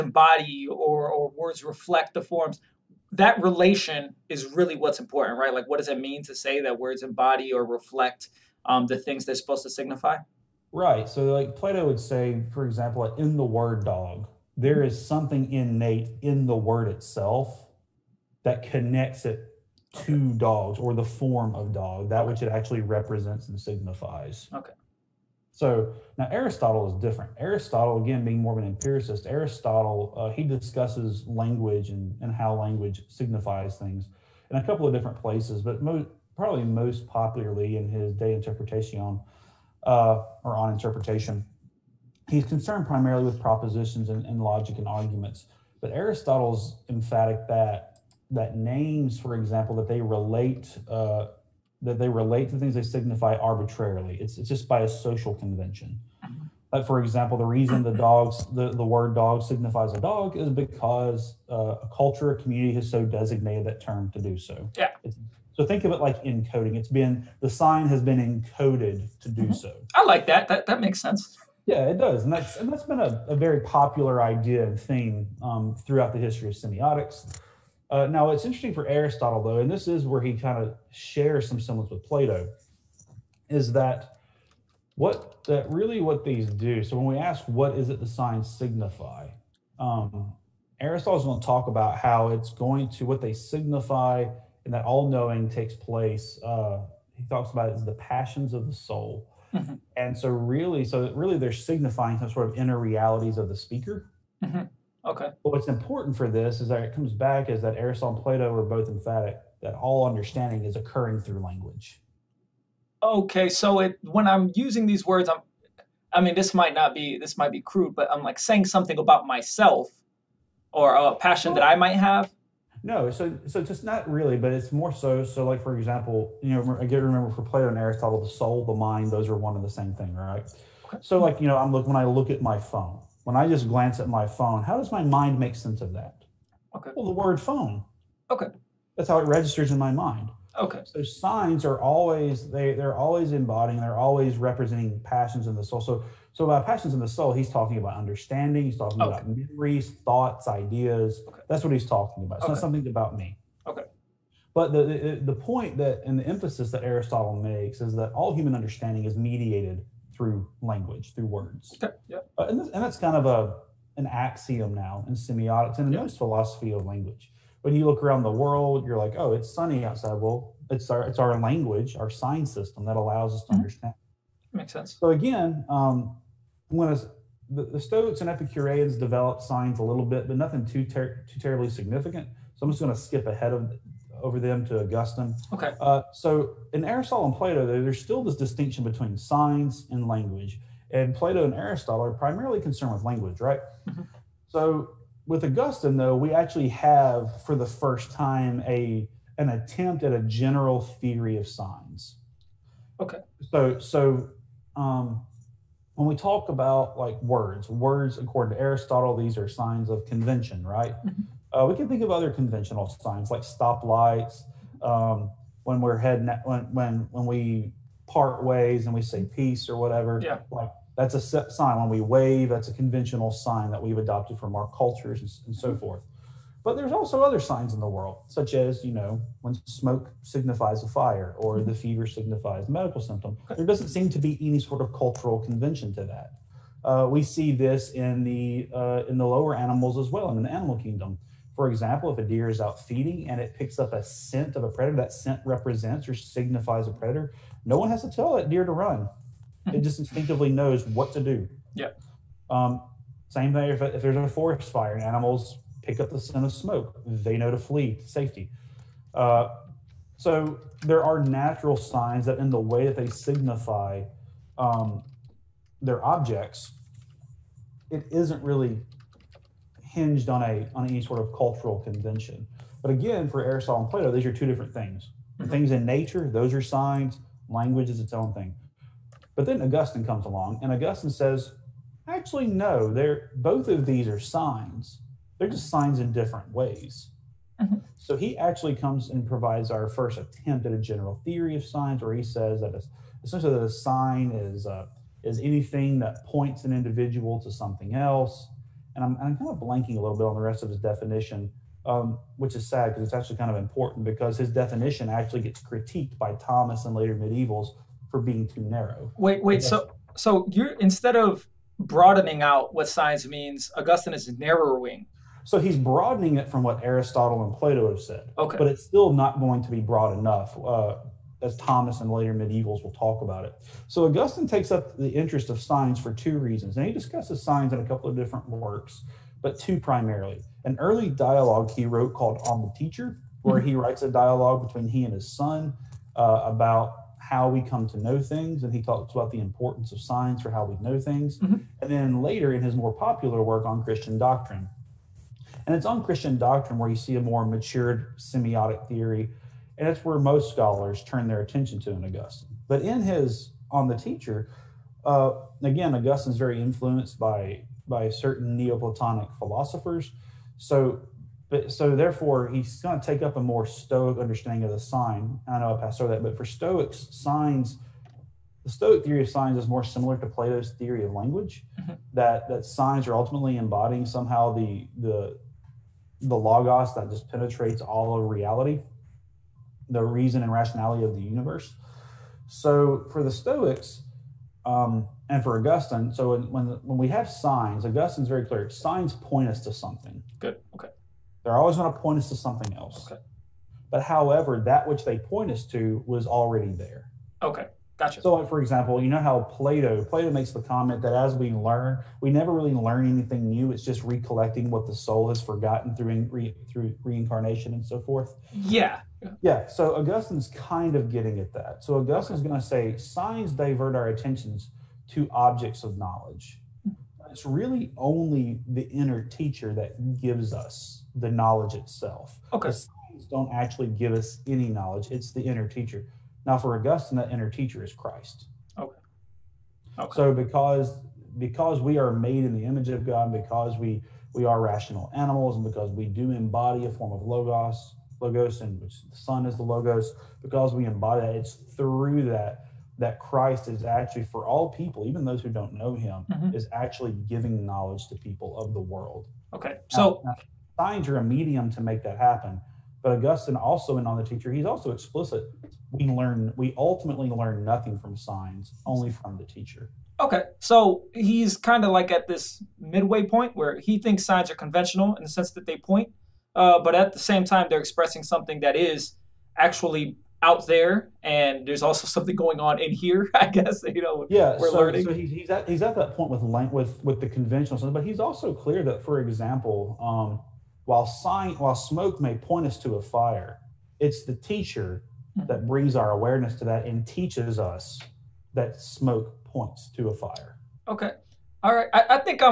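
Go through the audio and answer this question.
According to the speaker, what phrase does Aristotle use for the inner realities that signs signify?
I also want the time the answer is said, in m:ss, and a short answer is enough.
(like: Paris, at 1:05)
passions of the soul, at 1:37.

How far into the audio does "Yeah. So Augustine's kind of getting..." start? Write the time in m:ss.
6:49.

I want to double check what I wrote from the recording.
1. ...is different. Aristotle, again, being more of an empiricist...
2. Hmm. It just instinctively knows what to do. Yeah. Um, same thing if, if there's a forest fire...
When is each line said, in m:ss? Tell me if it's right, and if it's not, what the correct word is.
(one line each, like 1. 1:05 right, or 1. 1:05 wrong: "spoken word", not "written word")
1. 0:26 right
2. 4:09 right.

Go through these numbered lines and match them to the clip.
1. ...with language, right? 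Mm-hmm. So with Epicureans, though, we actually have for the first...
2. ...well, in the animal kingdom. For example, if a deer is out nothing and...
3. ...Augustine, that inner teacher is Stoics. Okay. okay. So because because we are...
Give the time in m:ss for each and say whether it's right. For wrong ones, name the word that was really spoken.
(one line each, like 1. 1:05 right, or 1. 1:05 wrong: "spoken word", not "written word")
1. 3:12 wrong: "Augustine", not "Epicureans"
2. 4:00 wrong: "feeding", not "nothing"
3. 7:06 wrong: "Christ", not "Stoics".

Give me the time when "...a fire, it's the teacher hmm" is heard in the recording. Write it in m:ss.
8:02.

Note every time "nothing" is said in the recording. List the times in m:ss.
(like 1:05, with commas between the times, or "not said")
3:00, 7:37.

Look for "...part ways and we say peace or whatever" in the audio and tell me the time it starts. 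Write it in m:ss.
3:38.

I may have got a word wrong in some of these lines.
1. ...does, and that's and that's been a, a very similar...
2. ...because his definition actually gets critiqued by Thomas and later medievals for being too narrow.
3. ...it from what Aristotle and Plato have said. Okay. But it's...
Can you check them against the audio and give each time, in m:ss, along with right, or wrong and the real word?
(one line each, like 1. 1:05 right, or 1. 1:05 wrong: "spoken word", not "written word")
1. 1:11 wrong: "popular", not "similar"
2. 5:04 right
3. 5:16 right.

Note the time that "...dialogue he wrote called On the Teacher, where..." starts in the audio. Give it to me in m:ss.
5:31.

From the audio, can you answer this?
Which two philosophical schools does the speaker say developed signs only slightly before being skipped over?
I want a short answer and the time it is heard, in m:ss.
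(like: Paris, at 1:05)
Stoics and Epicureans, at 2:57.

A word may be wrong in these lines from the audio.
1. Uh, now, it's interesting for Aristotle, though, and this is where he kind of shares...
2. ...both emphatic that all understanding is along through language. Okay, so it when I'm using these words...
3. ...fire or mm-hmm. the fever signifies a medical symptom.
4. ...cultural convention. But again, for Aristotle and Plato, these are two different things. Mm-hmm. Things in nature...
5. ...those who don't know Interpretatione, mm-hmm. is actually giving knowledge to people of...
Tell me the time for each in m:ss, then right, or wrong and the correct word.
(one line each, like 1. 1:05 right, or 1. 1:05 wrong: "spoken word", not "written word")
1. 1:17 right
2. 1:48 wrong: "occurring", not "along"
3. 3:50 right
4. 4:31 right
5. 7:25 wrong: "Him", not "Interpretatione".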